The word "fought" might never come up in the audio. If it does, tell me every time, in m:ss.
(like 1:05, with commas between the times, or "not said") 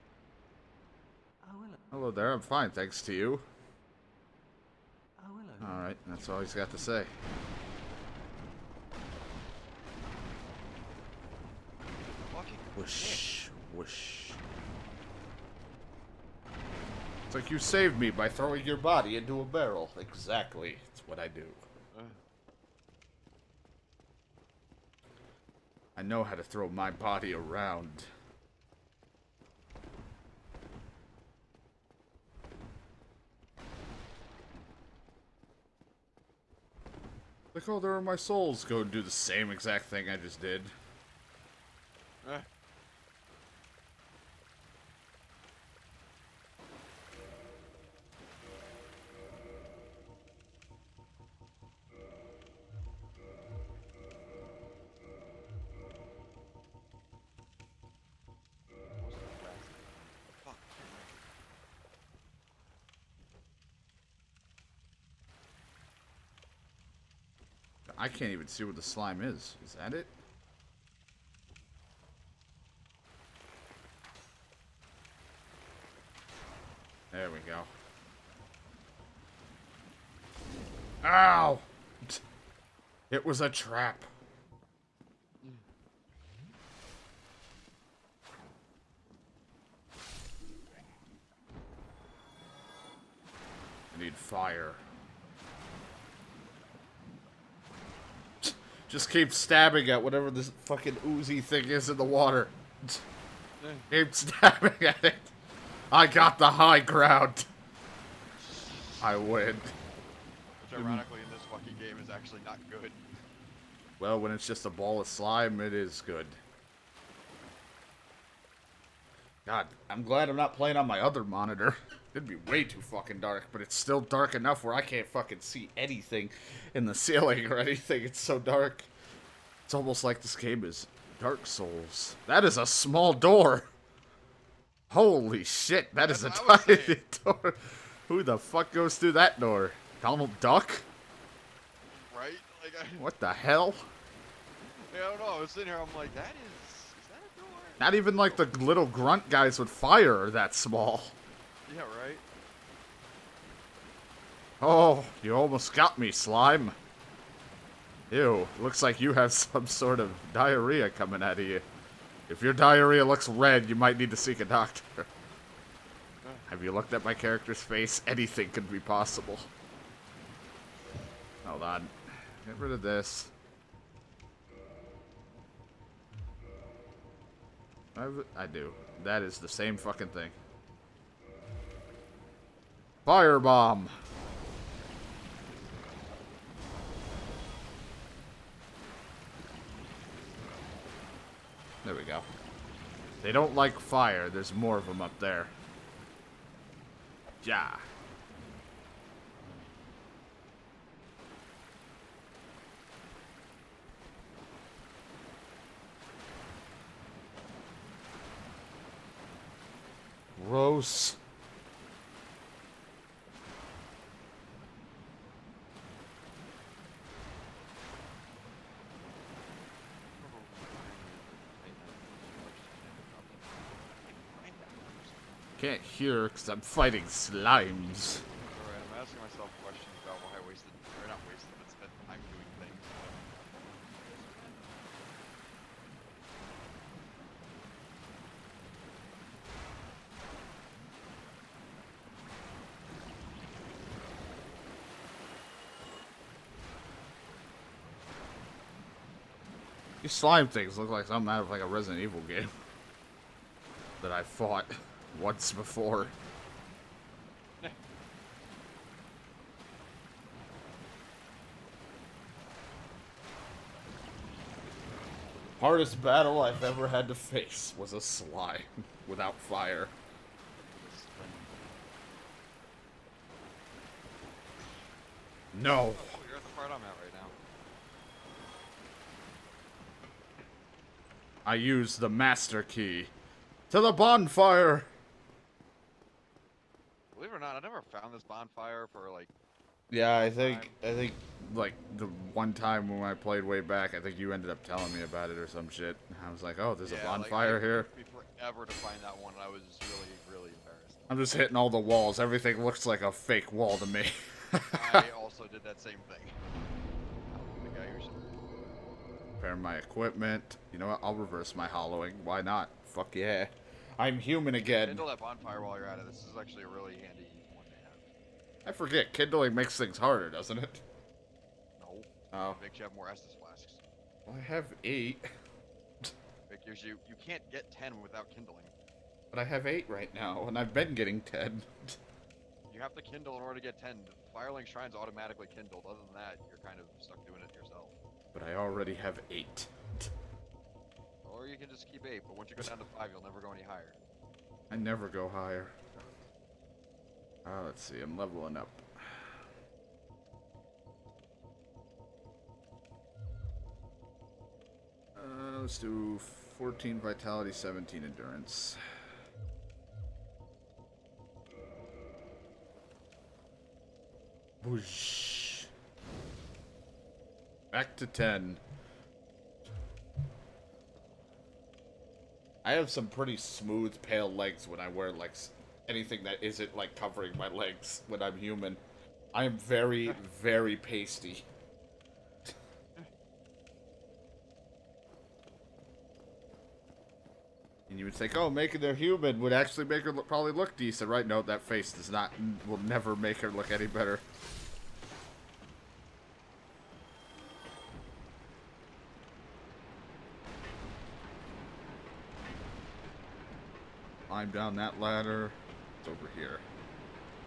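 4:14.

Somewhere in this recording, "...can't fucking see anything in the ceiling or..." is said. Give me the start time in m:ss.
2:04.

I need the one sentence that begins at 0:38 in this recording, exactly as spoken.
Go and do the same exact thing I just did.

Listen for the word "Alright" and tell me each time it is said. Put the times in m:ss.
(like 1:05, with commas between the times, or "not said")
0:05, 3:47.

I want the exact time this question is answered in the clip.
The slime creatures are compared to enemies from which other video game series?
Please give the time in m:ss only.
4:11.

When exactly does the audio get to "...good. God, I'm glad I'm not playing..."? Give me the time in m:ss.
1:56.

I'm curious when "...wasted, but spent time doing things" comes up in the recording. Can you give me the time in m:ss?
3:51.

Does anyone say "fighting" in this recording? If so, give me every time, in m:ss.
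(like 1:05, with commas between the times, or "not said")
3:46.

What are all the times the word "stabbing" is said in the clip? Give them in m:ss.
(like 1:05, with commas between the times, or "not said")
1:39, 1:44.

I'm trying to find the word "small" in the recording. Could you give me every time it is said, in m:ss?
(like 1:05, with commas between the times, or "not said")
2:12, 2:30.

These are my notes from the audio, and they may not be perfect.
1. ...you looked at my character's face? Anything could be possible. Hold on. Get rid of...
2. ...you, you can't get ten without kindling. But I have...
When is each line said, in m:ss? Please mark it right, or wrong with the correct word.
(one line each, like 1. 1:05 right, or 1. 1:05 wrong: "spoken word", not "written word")
1. 2:46 right
2. 5:26 right.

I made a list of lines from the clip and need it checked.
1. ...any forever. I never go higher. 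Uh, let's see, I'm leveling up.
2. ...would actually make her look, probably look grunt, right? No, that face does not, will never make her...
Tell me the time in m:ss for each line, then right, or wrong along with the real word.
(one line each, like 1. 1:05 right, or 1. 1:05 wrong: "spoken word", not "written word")
1. 5:43 wrong: "higher", not "forever"
2. 6:29 wrong: "decent", not "grunt".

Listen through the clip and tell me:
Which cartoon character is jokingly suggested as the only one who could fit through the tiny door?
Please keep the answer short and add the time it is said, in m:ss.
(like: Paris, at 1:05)
Donald Duck, at 2:20.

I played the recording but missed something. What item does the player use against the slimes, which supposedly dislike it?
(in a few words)
Firebomb.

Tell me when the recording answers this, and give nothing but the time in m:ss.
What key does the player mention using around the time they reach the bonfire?
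4:42.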